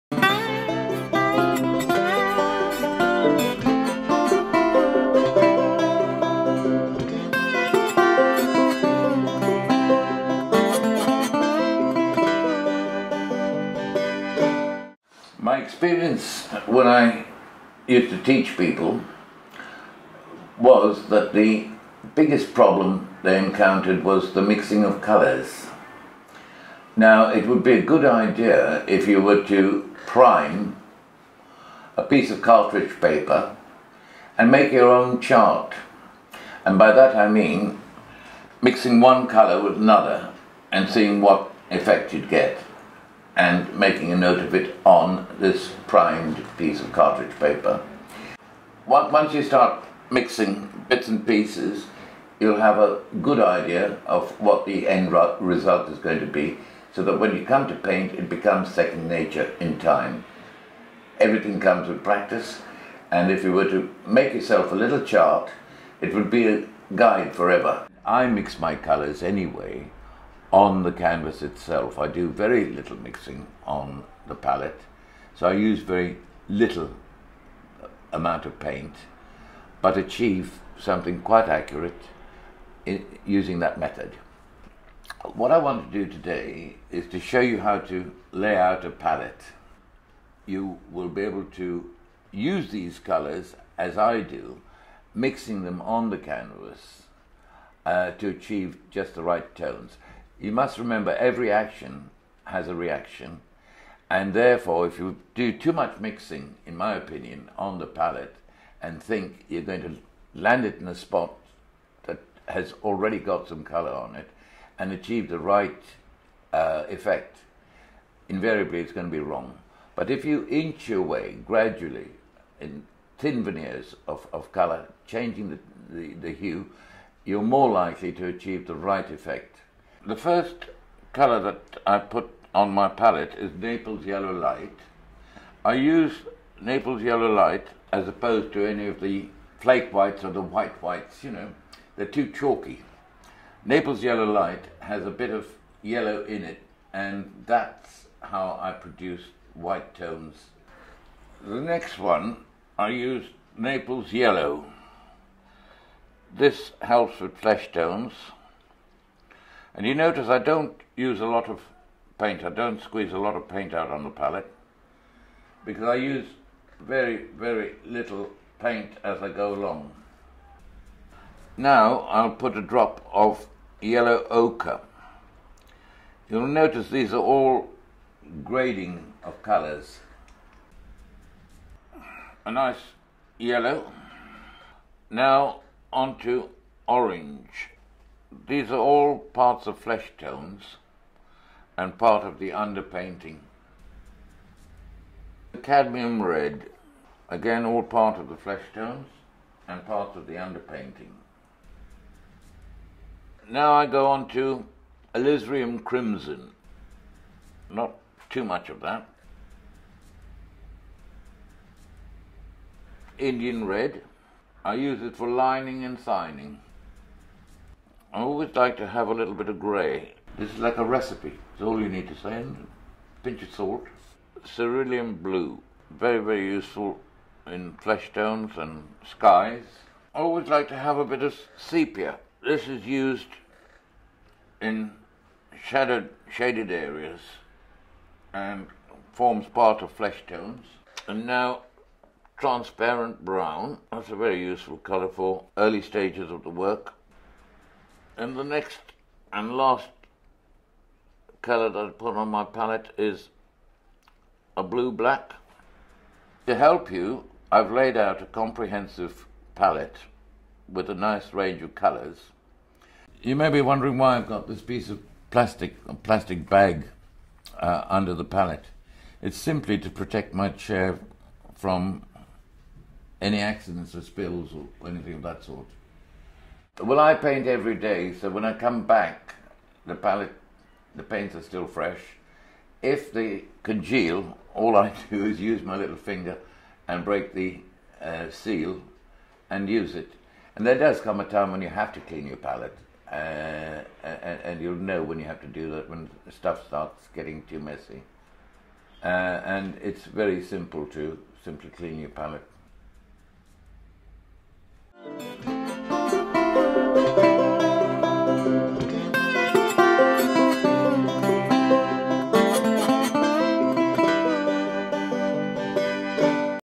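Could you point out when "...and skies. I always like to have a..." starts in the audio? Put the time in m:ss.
3:48.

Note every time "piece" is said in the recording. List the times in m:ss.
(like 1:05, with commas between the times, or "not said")
0:32, 0:46, 0:51, 4:24.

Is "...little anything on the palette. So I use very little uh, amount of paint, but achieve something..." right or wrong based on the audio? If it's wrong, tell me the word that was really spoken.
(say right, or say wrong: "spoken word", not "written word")
wrong: "mixing", not "anything".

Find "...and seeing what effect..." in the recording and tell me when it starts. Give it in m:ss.
0:40.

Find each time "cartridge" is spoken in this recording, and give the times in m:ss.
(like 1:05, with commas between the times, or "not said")
0:32, 0:46.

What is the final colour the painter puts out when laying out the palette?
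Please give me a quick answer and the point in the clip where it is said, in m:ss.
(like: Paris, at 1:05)
Blue-black, at 4:14.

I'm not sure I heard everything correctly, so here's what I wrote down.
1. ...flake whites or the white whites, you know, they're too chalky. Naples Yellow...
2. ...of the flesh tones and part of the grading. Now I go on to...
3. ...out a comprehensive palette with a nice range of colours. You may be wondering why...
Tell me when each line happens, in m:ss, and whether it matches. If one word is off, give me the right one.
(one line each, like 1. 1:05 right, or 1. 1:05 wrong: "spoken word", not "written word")
1. 2:19 right
2. 3:18 wrong: "underpainting", not "grading"
3. 4:17 right.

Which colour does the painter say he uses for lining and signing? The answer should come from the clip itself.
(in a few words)
Indian red.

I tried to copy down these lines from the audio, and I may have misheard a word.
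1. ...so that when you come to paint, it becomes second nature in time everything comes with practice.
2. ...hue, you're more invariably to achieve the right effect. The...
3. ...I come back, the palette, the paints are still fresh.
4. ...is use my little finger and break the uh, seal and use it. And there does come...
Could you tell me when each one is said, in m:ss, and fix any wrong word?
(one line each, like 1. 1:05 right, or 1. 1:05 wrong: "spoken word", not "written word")
1. 0:56 right
2. 2:06 wrong: "likely", not "invariably"
3. 4:38 right
4. 4:45 right.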